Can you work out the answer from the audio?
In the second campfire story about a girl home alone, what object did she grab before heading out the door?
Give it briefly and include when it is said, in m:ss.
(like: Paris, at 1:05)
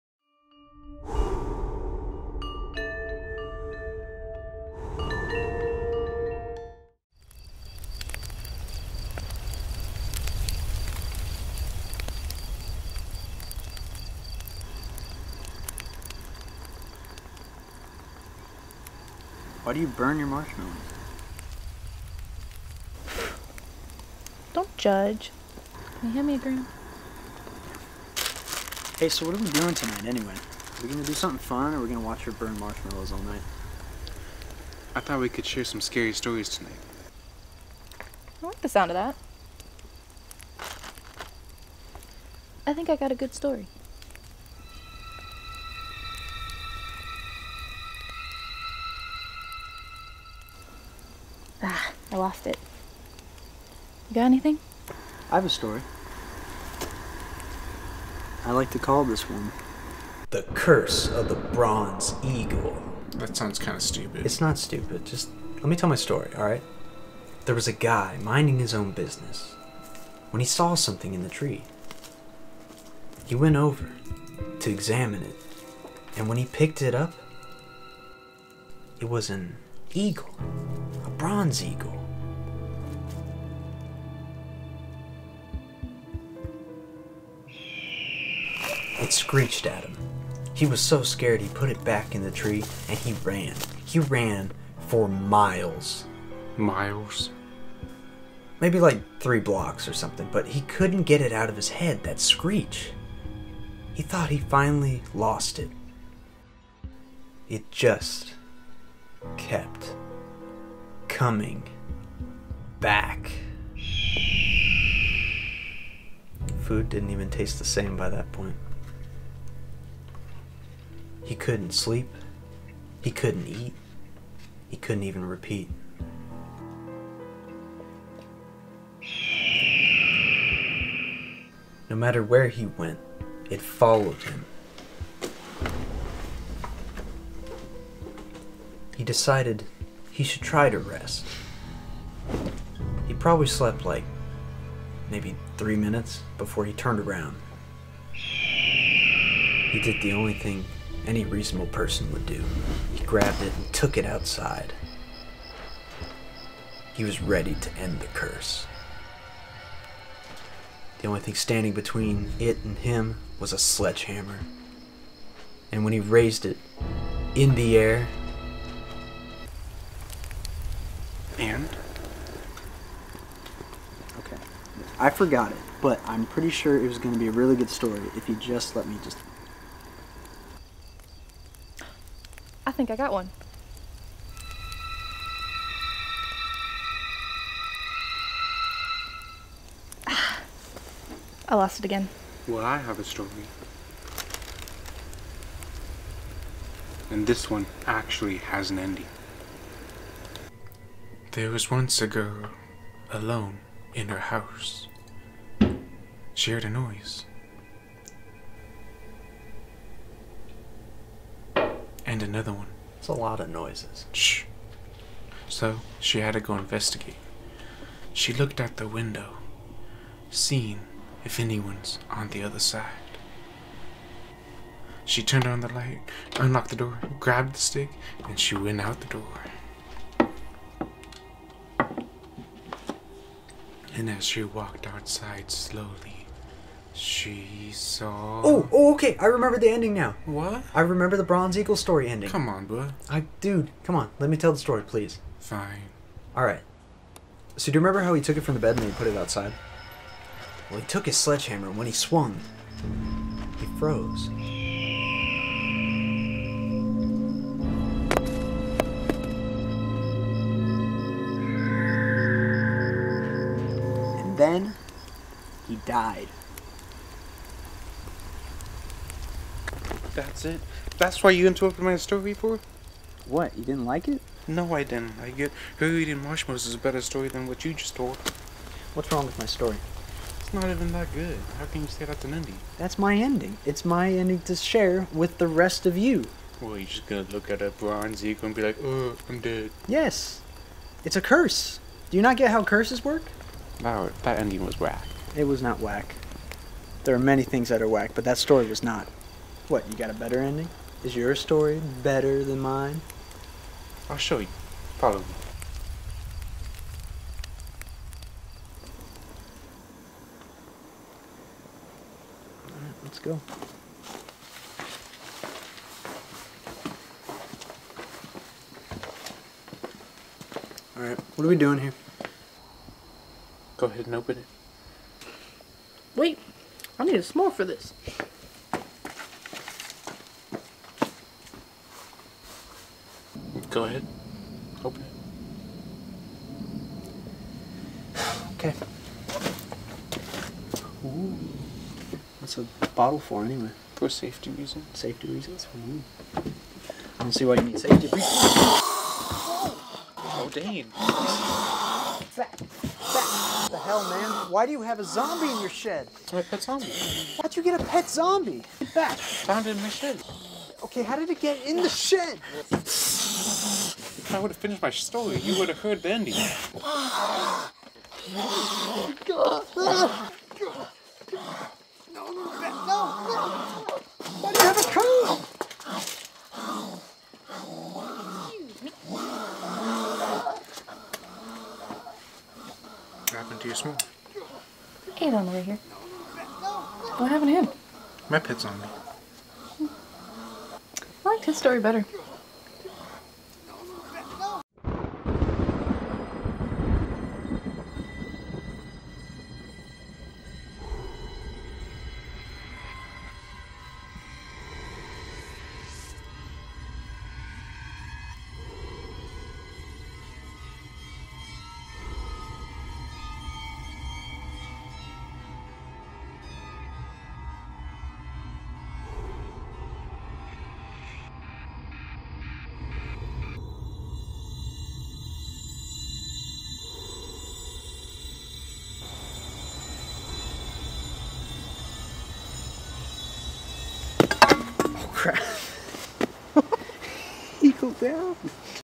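stick, at 3:47.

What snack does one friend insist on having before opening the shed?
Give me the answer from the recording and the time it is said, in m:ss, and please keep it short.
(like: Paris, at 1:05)
s'more, at 5:27.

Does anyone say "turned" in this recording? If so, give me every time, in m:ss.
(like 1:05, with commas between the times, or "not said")
2:26, 3:45.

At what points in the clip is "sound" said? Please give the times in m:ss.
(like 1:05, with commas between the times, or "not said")
0:38, 1:03.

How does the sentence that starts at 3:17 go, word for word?
And this one actually has an ending.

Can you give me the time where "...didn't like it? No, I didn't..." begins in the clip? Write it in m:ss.
4:33.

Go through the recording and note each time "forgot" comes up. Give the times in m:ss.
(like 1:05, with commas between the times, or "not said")
2:55.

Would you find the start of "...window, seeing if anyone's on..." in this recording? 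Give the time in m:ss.
3:38.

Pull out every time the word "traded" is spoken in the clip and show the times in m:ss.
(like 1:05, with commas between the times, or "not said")
not said.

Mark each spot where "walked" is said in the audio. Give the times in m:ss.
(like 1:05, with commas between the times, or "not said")
3:54.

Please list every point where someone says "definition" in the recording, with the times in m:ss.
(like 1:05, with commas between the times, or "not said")
not said.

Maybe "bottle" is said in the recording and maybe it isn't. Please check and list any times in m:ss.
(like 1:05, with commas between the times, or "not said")
5:42.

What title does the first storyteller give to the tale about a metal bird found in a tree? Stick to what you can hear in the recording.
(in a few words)
The Curse of the Bronze Eagle.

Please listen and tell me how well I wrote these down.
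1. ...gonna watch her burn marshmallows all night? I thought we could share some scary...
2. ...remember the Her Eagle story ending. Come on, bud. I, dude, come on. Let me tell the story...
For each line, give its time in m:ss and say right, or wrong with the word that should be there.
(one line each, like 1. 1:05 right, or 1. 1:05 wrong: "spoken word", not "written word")
1. 0:31 right
2. 4:00 wrong: "Bronze", not "Her".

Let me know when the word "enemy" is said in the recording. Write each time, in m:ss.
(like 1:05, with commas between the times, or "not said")
not said.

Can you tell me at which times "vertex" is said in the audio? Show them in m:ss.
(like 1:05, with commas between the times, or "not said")
not said.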